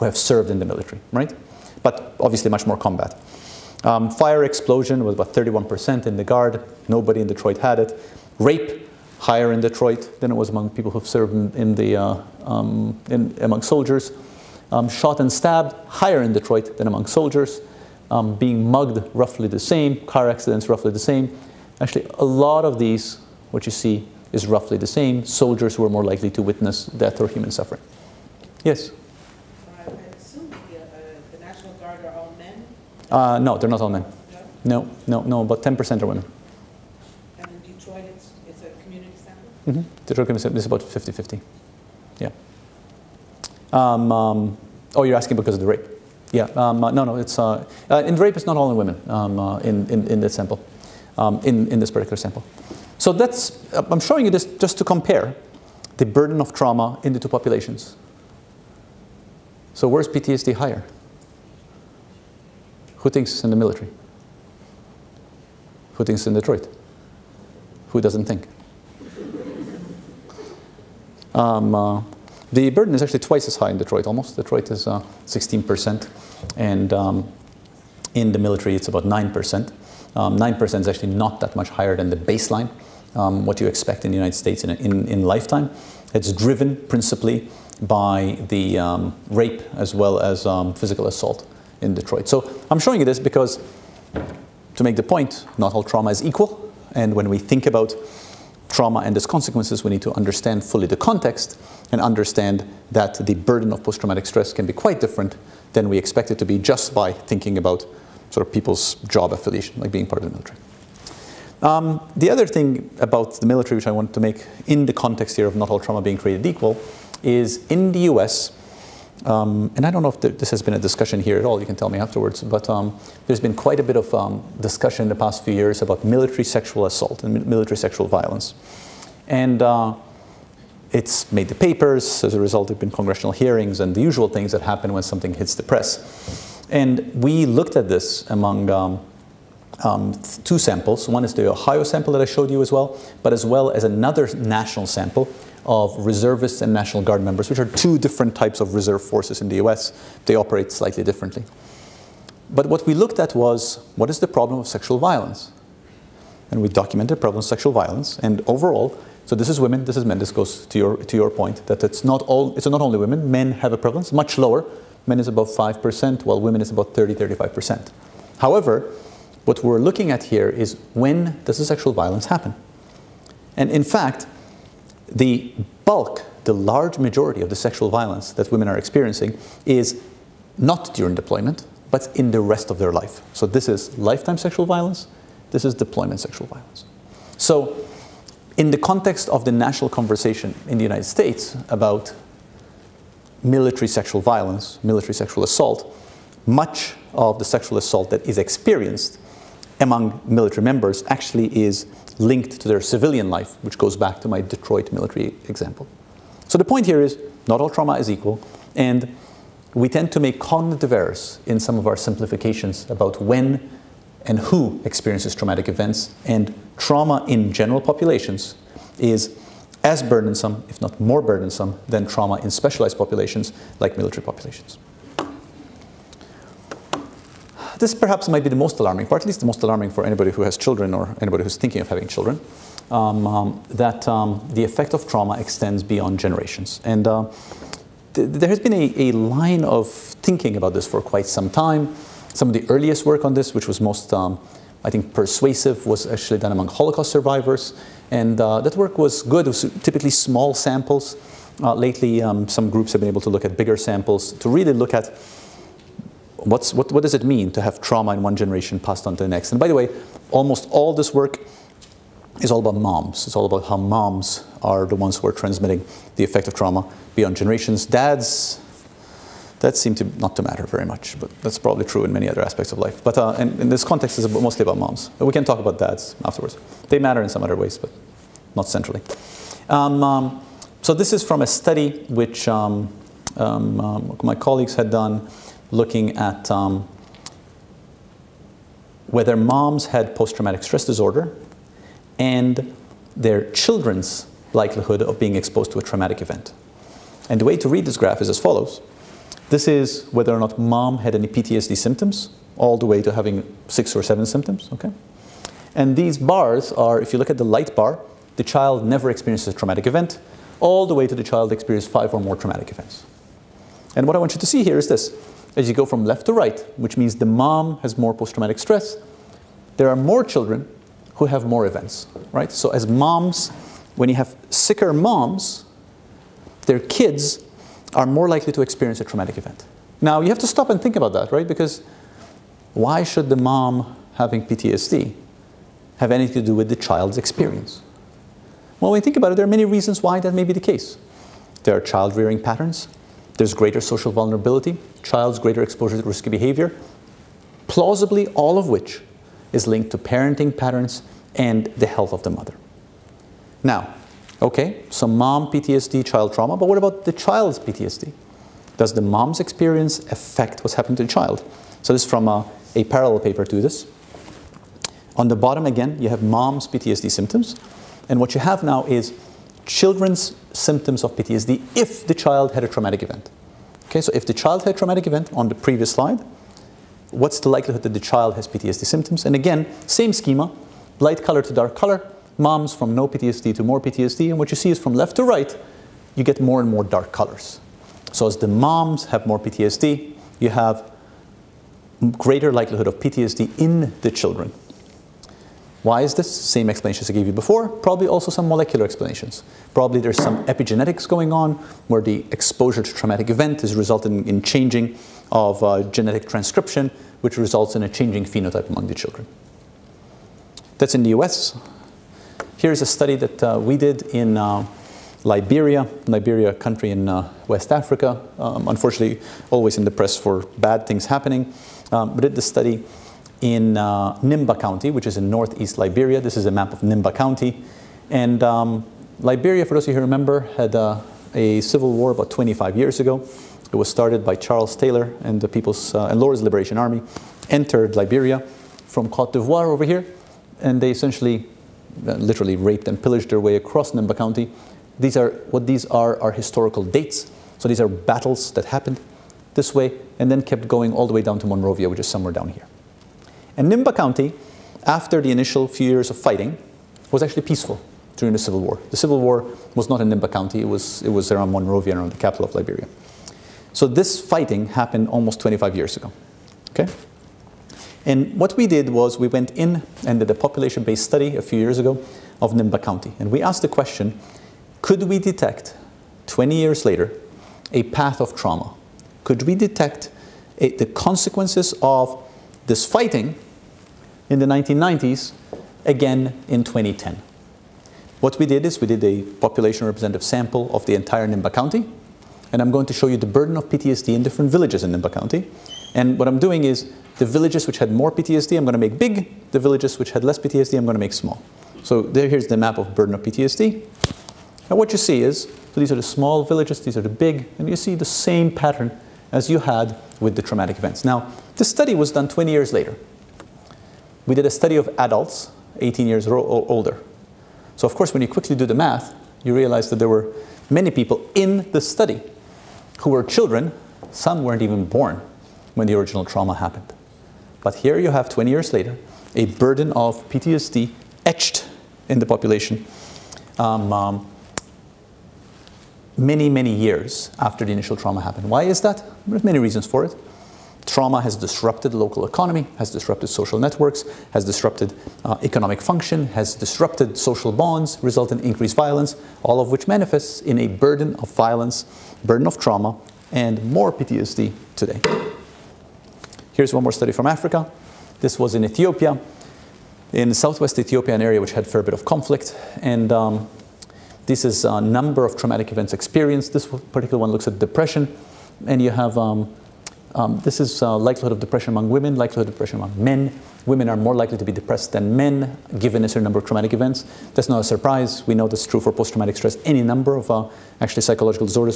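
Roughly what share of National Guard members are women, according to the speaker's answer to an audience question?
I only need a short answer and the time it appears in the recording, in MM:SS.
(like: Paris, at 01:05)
10%, at 00:35.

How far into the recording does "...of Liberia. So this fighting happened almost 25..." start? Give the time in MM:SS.
07:42.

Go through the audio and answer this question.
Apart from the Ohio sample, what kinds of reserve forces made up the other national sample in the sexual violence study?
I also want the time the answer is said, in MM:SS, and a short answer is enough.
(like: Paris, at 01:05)
reservists and National Guard, at 02:26.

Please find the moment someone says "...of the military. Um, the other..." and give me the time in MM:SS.
01:50.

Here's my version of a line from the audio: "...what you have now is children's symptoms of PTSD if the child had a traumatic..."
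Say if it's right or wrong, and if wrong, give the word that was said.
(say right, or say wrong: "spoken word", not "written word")
right.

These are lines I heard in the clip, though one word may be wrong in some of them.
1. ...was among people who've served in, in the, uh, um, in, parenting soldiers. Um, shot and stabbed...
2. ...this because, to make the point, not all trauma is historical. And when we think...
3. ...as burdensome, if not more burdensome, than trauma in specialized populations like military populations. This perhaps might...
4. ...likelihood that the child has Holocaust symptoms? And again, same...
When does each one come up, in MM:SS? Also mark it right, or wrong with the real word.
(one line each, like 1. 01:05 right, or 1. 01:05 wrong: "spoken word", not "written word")
1. 00:10 wrong: "among", not "parenting"
2. 01:33 wrong: "equal", not "historical"
3. 03:39 right
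4. 06:17 wrong: "PTSD", not "Holocaust".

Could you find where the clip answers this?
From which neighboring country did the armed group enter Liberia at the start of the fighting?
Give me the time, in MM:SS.
07:19.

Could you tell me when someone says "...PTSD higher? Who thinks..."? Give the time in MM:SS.
01:00.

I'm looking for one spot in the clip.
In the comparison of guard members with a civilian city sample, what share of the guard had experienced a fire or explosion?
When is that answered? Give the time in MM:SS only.
00:05.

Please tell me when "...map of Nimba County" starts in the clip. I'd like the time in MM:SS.
07:06.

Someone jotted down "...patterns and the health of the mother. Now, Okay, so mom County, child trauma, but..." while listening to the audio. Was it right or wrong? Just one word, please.
wrong.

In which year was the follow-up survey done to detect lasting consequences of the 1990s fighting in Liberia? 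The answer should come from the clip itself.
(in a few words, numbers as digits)
2010.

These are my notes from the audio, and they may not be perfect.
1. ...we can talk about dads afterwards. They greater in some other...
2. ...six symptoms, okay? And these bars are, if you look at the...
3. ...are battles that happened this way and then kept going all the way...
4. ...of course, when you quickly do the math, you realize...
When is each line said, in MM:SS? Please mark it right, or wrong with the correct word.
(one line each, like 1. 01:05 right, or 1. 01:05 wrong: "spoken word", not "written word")
1. 04:35 wrong: "matter", not "greater"
2. 05:04 wrong: "seven", not "six"
3. 07:27 right
4. 08:37 right.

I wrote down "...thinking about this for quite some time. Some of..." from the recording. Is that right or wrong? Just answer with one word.
right.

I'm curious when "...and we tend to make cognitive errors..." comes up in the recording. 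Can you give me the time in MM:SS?
03:28.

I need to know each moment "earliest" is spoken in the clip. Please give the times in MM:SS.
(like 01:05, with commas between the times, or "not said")
04:02.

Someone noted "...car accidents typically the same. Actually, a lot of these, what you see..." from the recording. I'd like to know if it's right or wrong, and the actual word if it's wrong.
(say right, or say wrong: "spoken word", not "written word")
wrong: "roughly", not "typically".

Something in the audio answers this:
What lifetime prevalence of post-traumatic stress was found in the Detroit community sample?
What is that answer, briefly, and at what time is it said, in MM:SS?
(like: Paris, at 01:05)
16%, at 01:14.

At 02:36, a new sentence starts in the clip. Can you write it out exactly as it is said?
And we documented the problem of sexual violence, and overall, so this is women, this is men.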